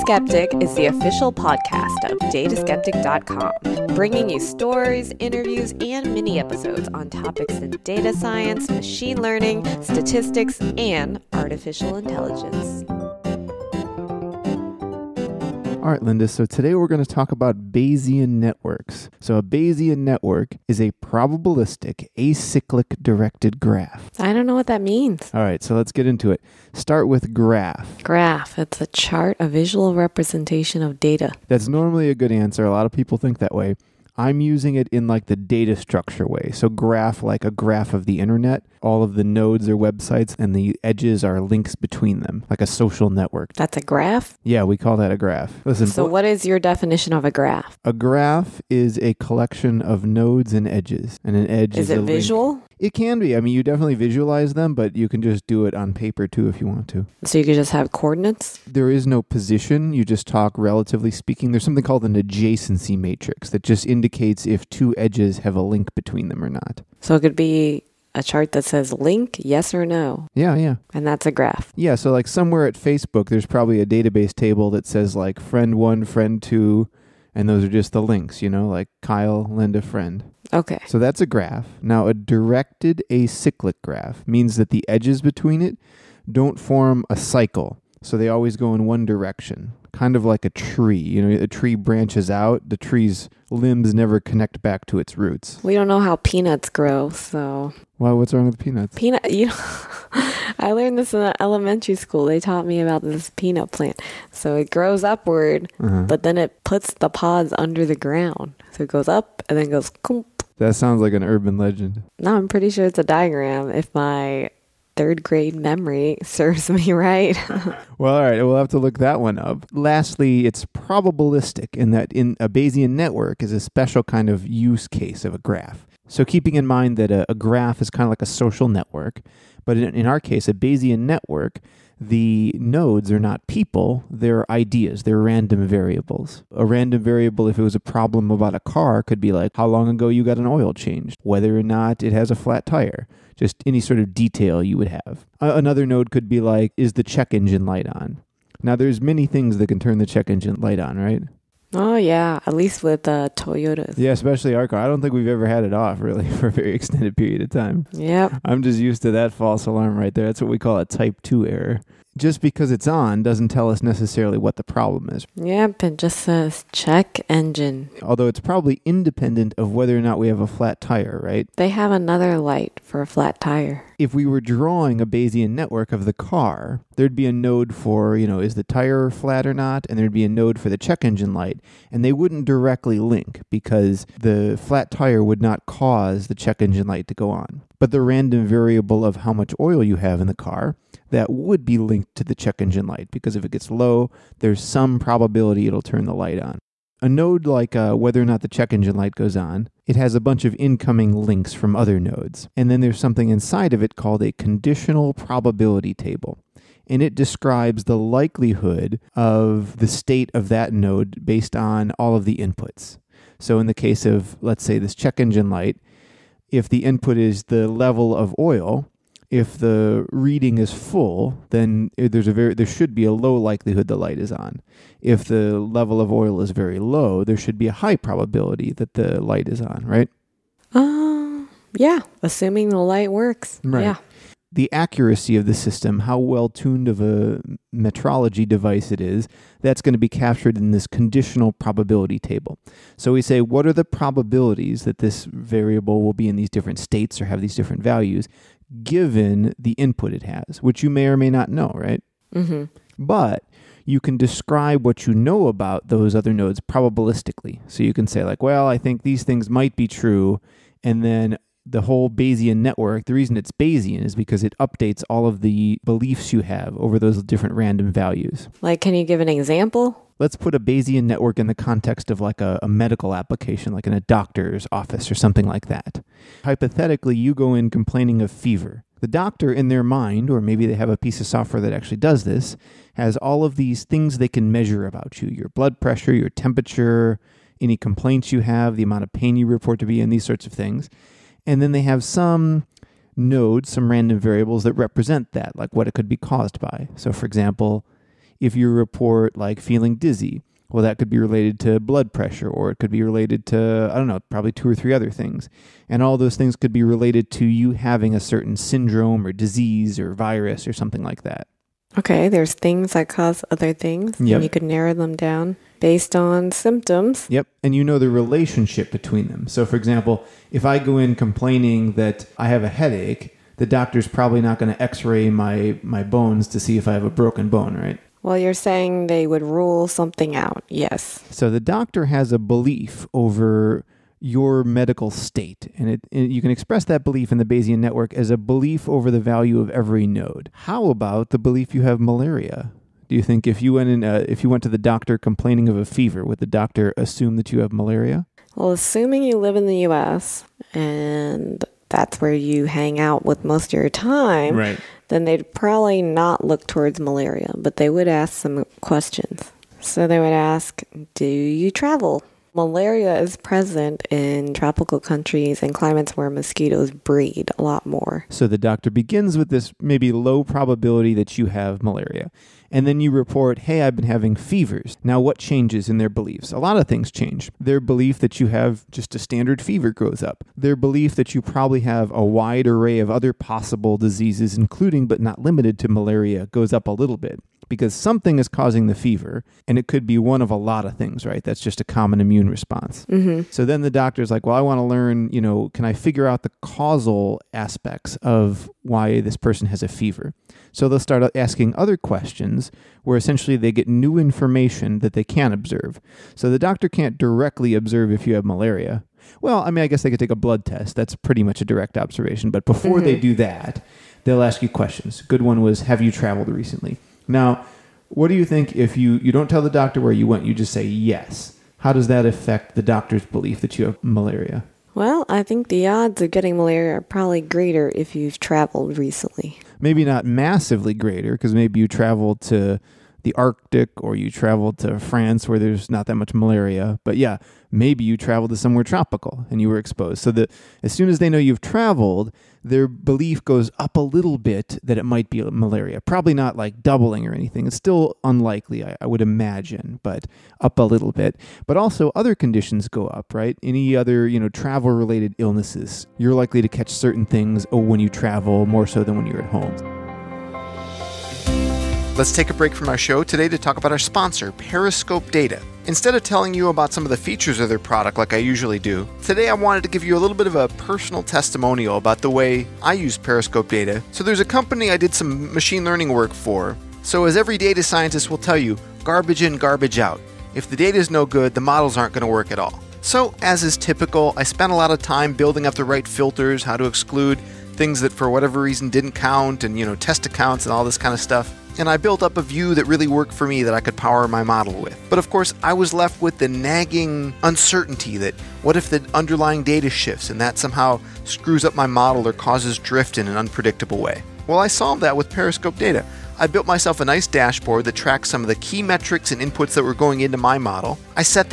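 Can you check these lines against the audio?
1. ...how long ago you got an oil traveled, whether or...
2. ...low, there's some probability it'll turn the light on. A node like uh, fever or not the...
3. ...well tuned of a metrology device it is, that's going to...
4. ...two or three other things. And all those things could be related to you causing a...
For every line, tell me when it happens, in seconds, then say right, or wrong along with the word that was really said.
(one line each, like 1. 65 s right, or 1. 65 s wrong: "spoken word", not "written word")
1. 139 s wrong: "changed", not "traveled"
2. 193 s wrong: "whether", not "fever"
3. 236 s right
4. 304 s wrong: "having", not "causing".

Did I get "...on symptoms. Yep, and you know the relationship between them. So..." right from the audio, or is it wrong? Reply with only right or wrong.
right.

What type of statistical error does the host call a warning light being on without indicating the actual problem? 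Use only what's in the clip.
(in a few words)
Type Two error.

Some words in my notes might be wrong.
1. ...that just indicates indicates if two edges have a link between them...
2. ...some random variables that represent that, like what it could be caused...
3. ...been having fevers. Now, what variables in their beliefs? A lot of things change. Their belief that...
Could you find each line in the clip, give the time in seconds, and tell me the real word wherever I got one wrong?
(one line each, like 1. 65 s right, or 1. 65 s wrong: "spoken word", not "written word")
1. 63 s right
2. 293 s right
3. 373 s wrong: "changes", not "variables".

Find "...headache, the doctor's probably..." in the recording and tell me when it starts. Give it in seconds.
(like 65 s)
322 s.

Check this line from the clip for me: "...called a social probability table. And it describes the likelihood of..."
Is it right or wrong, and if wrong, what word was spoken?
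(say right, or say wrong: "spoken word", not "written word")
wrong: "conditional", not "social".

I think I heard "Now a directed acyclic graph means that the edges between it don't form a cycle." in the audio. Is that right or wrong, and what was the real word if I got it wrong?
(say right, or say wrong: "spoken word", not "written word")
right.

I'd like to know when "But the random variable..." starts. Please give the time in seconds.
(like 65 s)
187 s.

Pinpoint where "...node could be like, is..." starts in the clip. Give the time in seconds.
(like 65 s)
145 s.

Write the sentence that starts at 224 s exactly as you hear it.
If the level of oil is very low, there should be a high probability that the light is on, right?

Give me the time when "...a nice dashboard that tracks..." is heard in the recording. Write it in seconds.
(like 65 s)
506 s.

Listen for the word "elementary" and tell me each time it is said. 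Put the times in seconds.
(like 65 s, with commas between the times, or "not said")
101 s.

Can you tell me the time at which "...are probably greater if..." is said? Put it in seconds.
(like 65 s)
426 s.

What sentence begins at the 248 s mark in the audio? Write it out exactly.
given the input it has, which you may or may not know, right?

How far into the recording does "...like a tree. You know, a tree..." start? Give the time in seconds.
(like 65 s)
90 s.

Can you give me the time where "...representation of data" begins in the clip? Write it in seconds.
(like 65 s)
29 s.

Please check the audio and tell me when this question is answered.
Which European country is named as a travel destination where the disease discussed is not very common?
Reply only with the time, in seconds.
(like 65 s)
434 s.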